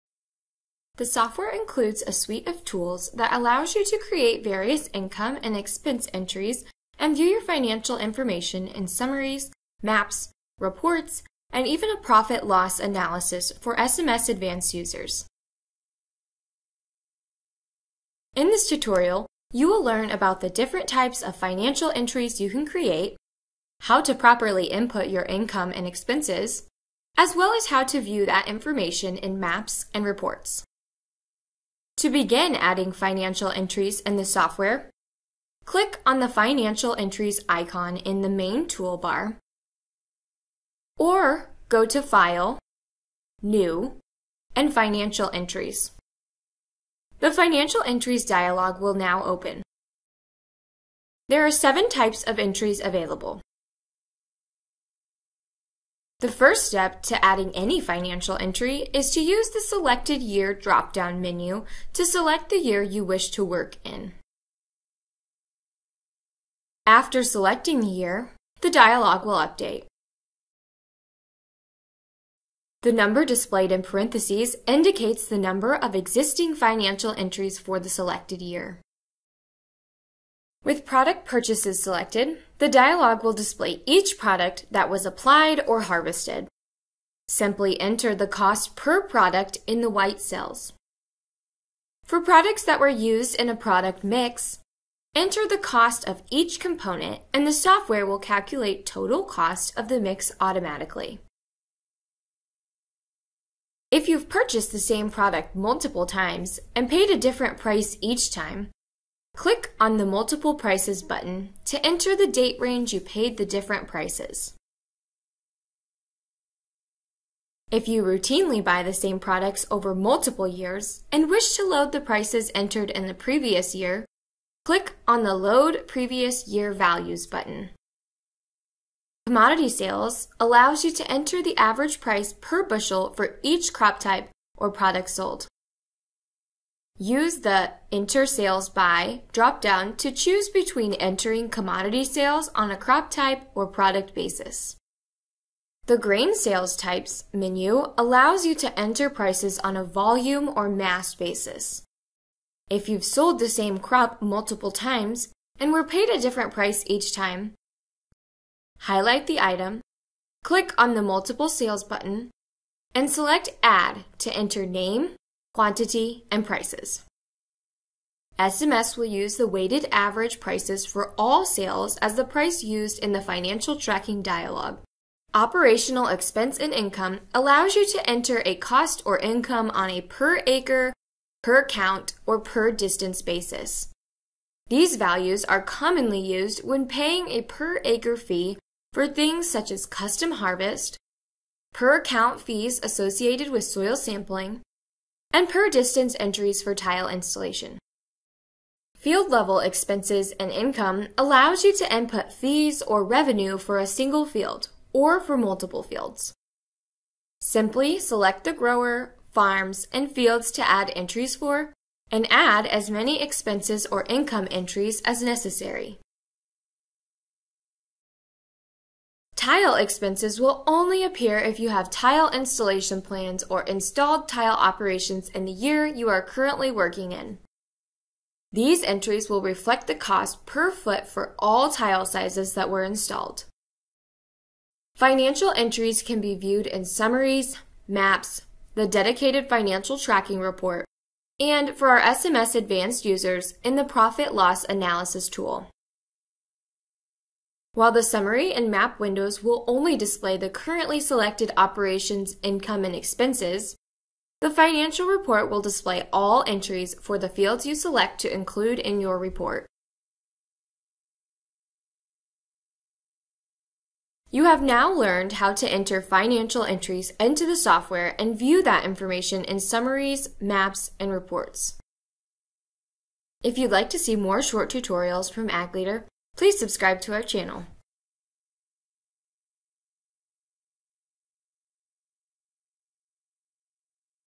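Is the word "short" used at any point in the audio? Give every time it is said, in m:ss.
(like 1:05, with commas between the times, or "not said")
4:34.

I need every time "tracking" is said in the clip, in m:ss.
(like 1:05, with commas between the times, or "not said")
2:53, 3:59.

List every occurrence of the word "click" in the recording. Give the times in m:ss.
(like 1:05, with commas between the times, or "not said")
0:35, 1:49, 2:04, 2:40.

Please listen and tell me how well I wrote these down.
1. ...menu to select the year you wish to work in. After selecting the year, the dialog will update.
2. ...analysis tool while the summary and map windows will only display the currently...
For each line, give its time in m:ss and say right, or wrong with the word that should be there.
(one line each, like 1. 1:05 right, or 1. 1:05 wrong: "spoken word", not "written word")
1. 1:01 right
2. 4:04 right.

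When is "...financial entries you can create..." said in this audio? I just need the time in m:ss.
0:21.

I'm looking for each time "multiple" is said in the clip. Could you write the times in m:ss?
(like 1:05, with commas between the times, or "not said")
1:45, 1:50, 1:59, 2:34, 2:41, 3:25.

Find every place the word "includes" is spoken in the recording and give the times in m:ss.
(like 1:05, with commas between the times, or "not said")
0:01, 4:18.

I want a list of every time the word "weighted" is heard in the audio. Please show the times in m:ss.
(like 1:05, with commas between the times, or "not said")
2:49.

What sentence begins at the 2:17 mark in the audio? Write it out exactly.
Use the Enter Sales By dropdown to choose between entering commodity sales on a crop type or product basis.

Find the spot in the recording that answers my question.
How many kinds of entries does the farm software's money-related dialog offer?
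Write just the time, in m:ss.
0:51.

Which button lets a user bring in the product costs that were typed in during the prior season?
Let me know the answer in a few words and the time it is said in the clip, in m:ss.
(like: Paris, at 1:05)
Load Previous Year Values, at 2:05.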